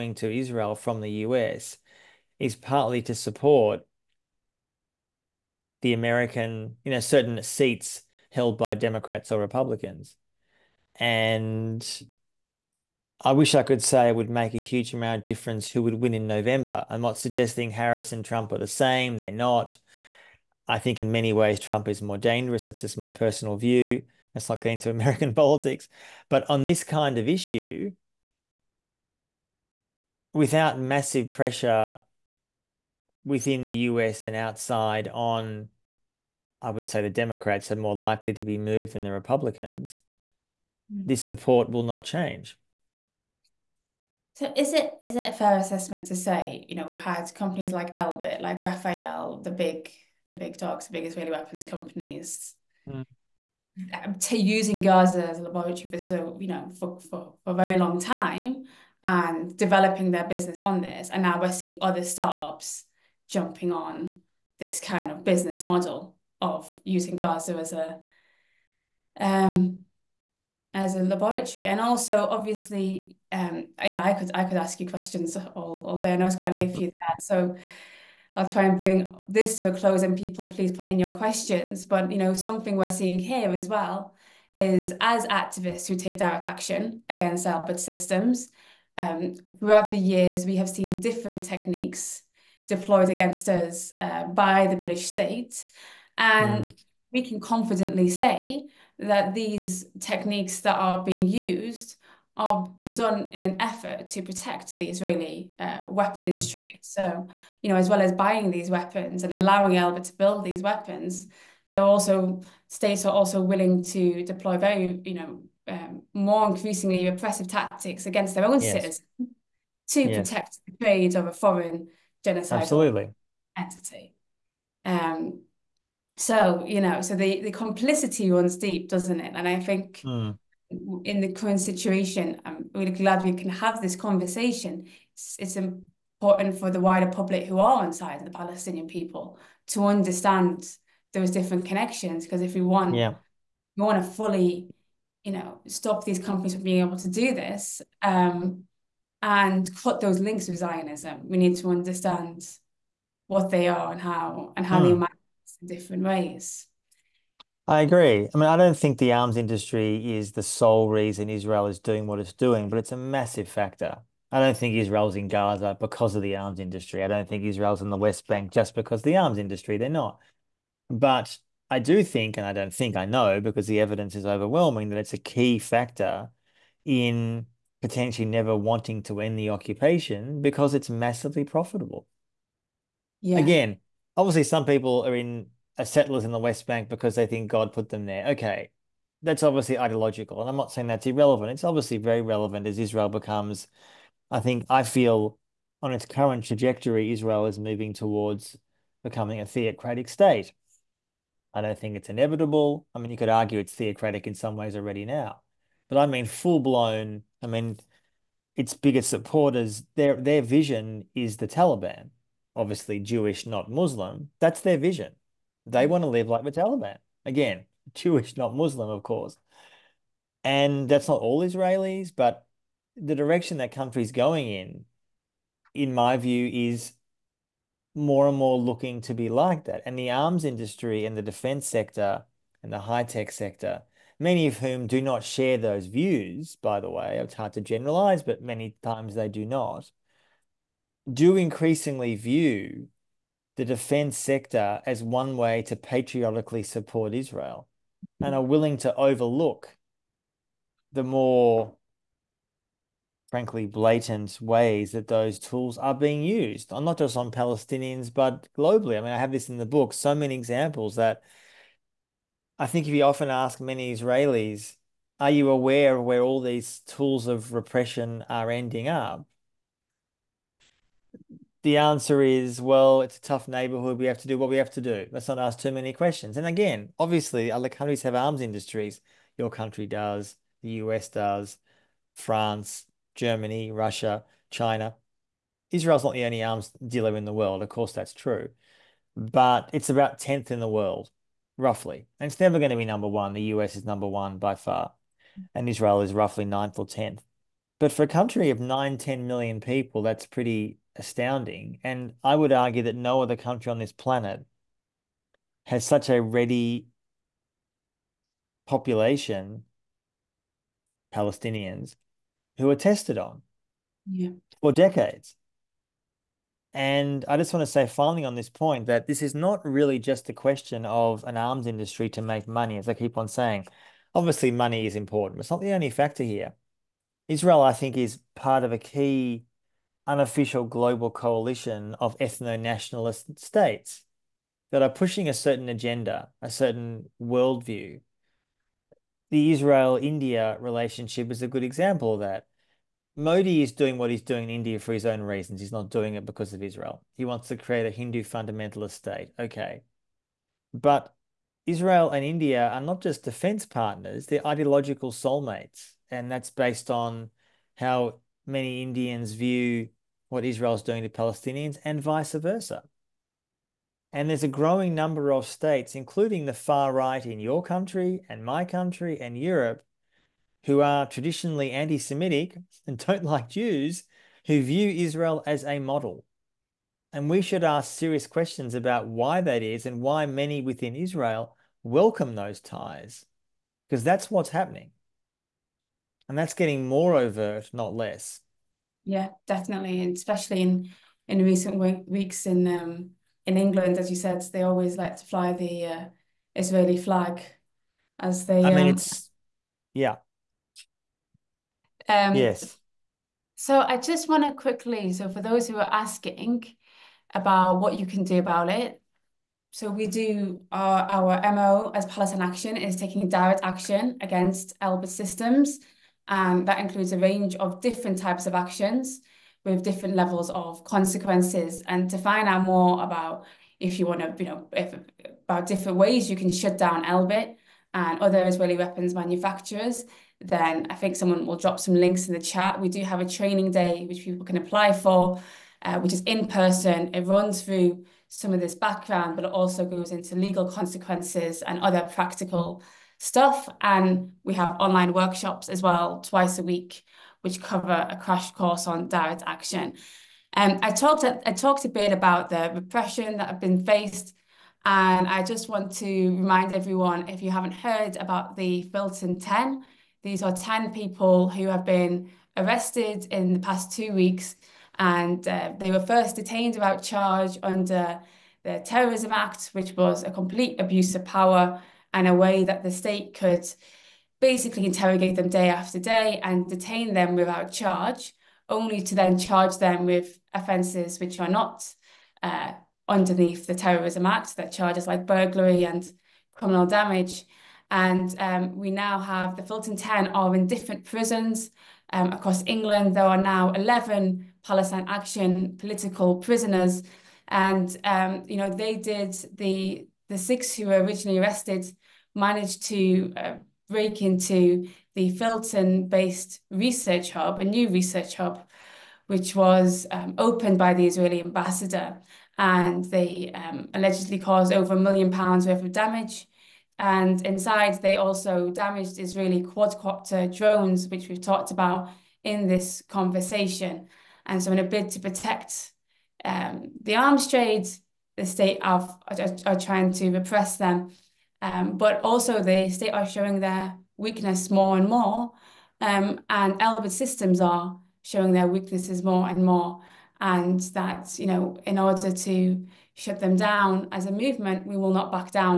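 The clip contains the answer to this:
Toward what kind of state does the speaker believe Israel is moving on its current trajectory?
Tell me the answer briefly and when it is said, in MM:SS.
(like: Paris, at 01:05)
theocratic state, at 03:19.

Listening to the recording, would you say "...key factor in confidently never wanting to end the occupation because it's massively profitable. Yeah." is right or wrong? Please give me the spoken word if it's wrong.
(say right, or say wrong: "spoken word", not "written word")
wrong: "potentially", not "confidently".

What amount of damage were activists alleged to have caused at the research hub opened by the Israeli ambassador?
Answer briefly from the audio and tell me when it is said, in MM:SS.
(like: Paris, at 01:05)
over a million pounds, at 08:34.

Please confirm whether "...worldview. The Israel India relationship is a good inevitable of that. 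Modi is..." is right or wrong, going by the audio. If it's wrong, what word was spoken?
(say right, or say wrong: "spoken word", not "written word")
wrong: "example", not "inevitable".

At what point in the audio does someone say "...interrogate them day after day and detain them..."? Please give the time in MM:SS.
07:54.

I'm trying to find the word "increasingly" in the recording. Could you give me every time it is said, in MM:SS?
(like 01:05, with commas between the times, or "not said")
01:56, 04:01.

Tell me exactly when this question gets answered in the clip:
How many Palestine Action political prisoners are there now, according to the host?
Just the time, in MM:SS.
08:13.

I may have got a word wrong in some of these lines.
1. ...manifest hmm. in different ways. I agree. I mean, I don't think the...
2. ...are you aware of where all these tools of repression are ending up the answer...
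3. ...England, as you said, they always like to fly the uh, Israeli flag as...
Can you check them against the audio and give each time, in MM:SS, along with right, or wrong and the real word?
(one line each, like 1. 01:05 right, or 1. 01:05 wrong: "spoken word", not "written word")
1. 02:34 right
2. 04:25 right
3. 06:33 right.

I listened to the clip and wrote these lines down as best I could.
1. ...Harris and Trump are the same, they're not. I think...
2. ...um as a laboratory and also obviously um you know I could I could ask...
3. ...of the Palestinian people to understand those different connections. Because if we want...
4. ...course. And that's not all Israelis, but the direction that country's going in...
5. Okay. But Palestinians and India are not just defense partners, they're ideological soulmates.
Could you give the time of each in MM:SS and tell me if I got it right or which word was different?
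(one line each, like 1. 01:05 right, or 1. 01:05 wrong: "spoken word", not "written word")
1. 00:17 right
2. 01:09 right
3. 02:18 right
4. 03:39 right
5. 05:49 wrong: "Israel", not "Palestinians".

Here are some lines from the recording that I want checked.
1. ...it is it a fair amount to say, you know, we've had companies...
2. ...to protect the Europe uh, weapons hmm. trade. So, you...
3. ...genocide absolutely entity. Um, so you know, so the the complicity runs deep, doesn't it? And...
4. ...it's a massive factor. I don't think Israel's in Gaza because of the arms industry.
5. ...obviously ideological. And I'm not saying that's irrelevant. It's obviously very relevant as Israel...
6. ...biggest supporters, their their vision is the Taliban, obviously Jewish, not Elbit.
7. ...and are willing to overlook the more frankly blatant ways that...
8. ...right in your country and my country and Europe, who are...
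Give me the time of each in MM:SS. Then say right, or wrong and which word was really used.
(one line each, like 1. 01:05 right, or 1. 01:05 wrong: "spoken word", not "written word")
1. 00:44 wrong: "assessment", not "amount"
2. 01:44 wrong: "Israeli", not "Europe"
3. 02:02 right
4. 02:42 right
5. 03:09 right
6. 03:28 wrong: "Muslim", not "Elbit"
7. 04:08 right
8. 06:06 right.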